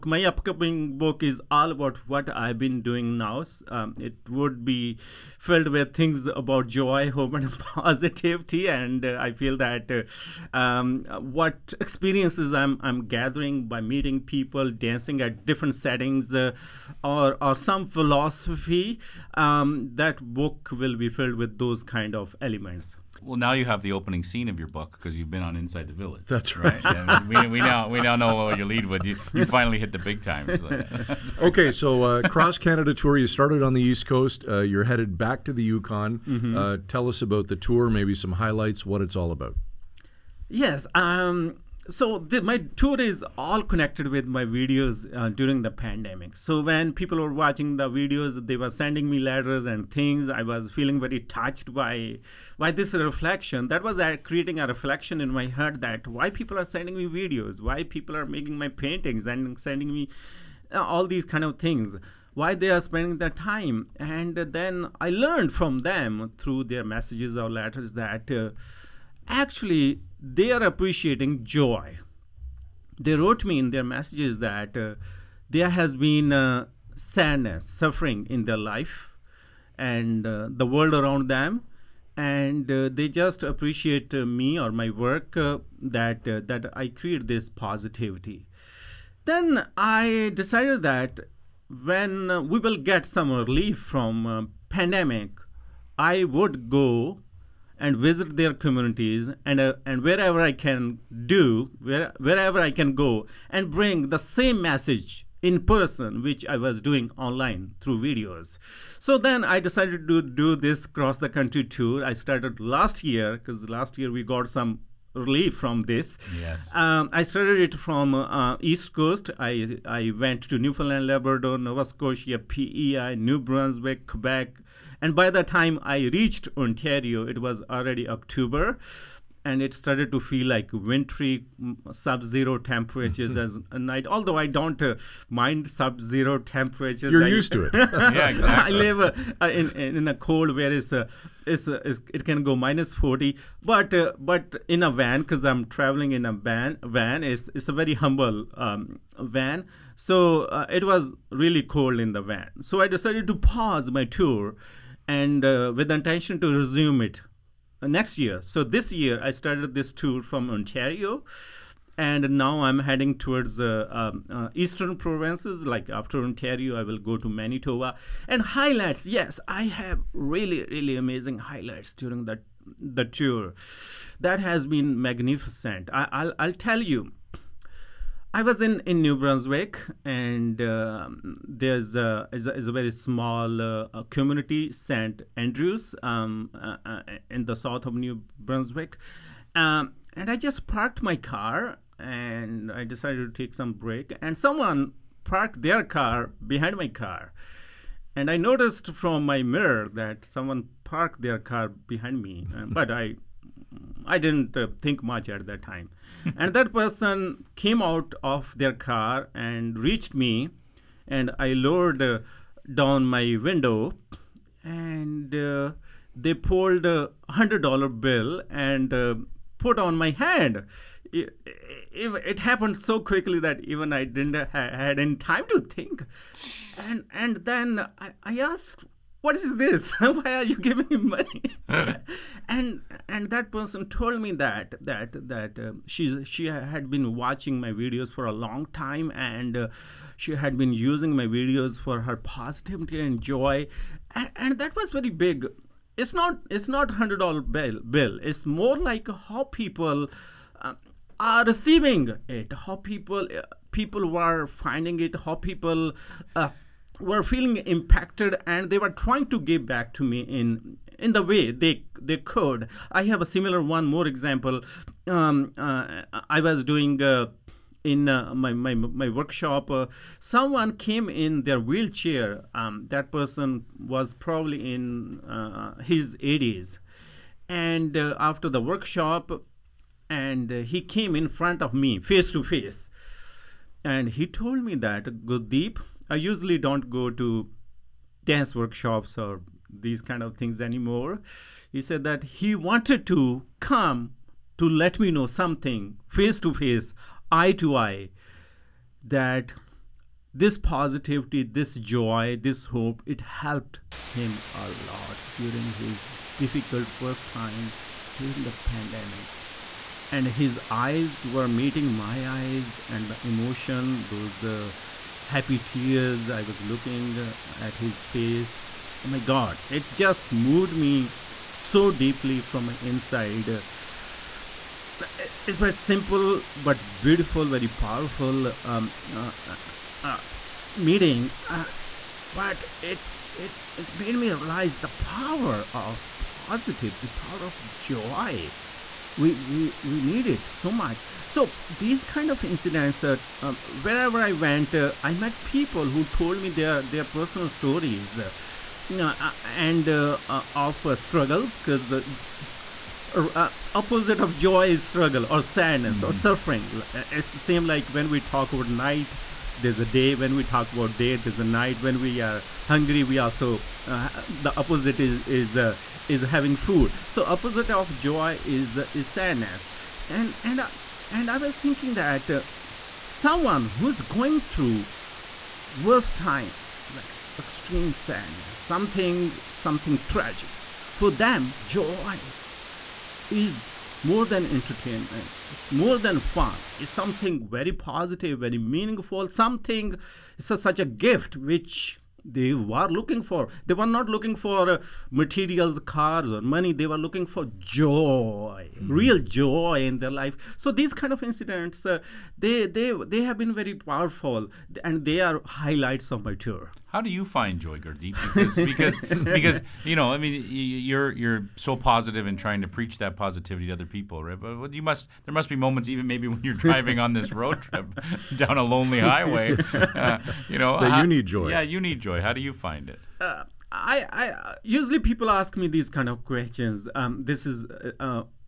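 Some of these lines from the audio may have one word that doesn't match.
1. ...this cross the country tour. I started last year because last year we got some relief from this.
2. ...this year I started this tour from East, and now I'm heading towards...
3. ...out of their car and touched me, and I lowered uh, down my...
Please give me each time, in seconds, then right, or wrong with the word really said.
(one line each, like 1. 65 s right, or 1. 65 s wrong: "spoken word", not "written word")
1. 110 s right
2. 158 s wrong: "Ontario", not "East"
3. 207 s wrong: "reached", not "touched".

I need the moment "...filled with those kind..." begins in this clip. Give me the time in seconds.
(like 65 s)
21 s.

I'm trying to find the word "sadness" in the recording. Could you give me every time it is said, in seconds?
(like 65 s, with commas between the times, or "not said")
76 s, 355 s, 369 s, 377 s.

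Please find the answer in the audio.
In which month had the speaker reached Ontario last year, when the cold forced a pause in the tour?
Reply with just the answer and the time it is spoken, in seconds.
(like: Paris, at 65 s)
October, at 128 s.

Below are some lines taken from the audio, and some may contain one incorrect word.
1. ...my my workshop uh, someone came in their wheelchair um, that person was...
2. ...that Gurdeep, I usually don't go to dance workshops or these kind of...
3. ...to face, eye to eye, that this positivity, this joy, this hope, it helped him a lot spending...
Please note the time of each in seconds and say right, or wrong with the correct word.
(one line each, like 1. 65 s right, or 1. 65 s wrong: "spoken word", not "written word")
1. 268 s right
2. 284 s right
3. 296 s wrong: "during", not "spending".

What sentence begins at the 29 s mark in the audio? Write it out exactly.
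You, you finally hit the big time.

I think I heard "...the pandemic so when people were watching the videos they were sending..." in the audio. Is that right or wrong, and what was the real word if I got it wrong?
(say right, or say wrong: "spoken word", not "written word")
right.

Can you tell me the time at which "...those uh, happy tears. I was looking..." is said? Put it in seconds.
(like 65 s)
314 s.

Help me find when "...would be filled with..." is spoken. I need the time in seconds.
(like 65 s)
4 s.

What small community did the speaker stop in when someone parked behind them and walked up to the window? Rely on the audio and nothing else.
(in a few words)
St. Andrews.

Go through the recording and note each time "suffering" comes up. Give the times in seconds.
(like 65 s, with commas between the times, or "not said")
77 s, 356 s.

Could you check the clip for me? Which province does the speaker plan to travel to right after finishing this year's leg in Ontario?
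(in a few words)
Manitoba.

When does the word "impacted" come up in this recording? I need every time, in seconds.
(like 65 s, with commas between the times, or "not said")
257 s.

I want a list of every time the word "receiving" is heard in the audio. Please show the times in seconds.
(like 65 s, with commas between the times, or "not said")
251 s.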